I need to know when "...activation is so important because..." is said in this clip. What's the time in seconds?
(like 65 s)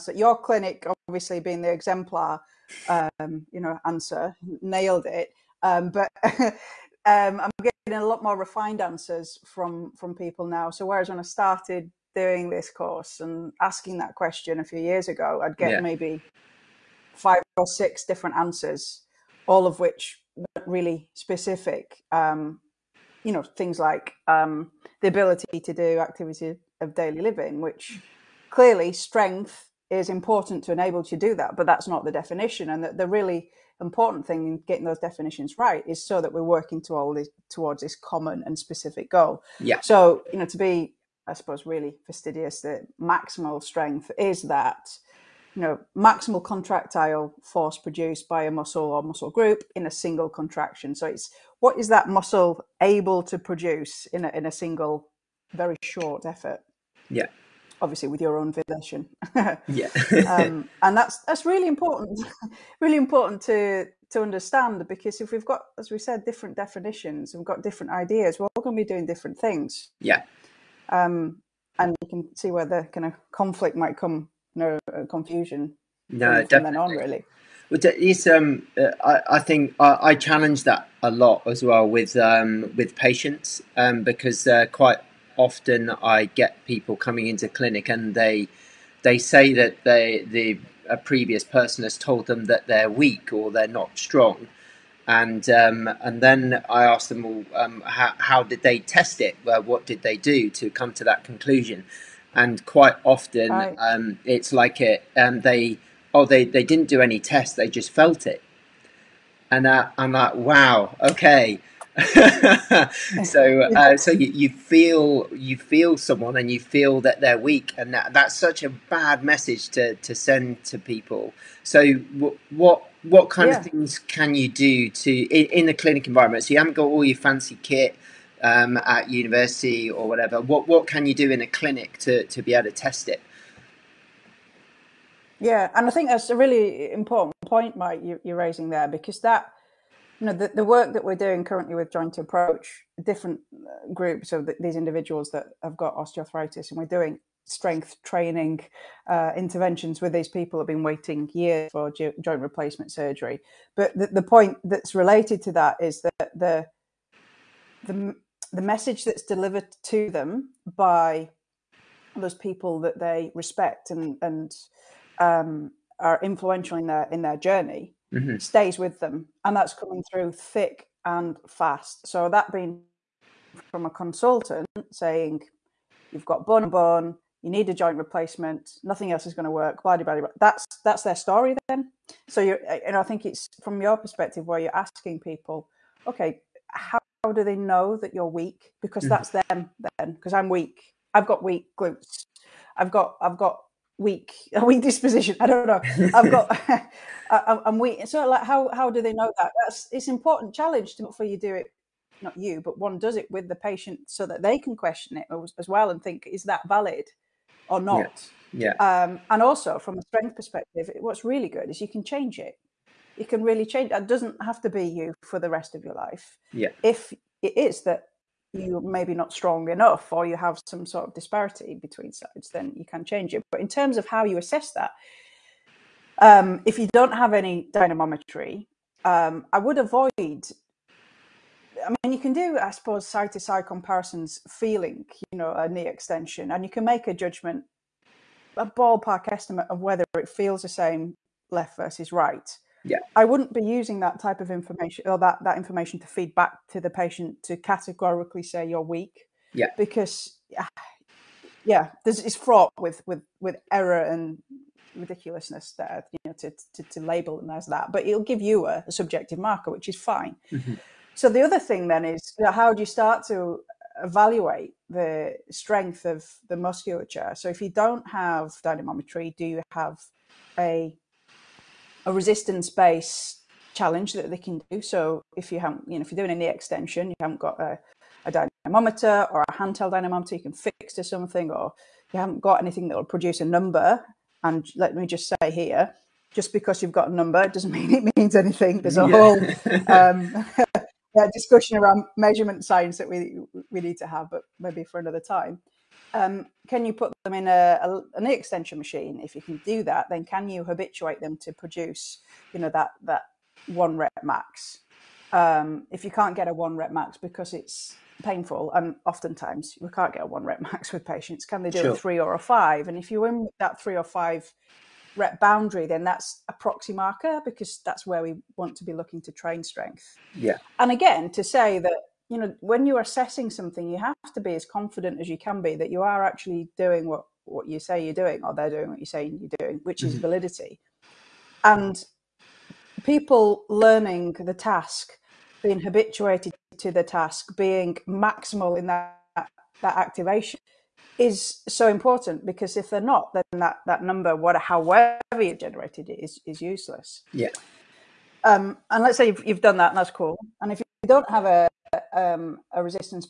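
339 s.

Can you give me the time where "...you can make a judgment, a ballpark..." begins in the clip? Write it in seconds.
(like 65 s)
236 s.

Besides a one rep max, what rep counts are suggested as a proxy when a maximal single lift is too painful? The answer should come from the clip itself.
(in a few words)
3 or 5.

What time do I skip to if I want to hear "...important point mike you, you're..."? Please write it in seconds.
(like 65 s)
136 s.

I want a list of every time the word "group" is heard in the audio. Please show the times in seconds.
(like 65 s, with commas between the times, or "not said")
49 s, 143 s.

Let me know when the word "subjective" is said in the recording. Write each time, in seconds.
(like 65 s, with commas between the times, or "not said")
258 s.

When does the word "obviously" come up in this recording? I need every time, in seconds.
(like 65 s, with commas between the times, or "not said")
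1 s, 57 s.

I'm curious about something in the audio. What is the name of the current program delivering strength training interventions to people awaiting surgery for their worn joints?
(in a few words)
Joint Approach.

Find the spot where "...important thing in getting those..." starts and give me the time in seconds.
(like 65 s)
33 s.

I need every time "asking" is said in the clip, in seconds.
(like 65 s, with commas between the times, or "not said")
13 s, 184 s.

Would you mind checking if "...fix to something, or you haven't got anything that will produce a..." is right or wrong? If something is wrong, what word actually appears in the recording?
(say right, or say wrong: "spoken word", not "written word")
right.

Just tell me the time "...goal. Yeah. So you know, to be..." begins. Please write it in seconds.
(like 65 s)
39 s.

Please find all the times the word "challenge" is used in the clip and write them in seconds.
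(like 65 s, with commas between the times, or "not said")
80 s, 200 s, 273 s.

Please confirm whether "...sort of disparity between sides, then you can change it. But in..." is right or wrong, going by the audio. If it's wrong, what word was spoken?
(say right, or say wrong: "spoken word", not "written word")
right.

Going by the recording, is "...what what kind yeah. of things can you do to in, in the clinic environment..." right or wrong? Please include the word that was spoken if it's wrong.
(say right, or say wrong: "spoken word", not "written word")
right.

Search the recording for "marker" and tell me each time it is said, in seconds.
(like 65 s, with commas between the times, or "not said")
259 s, 316 s.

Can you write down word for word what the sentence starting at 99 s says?
Well, what did they do to come to that conclusion?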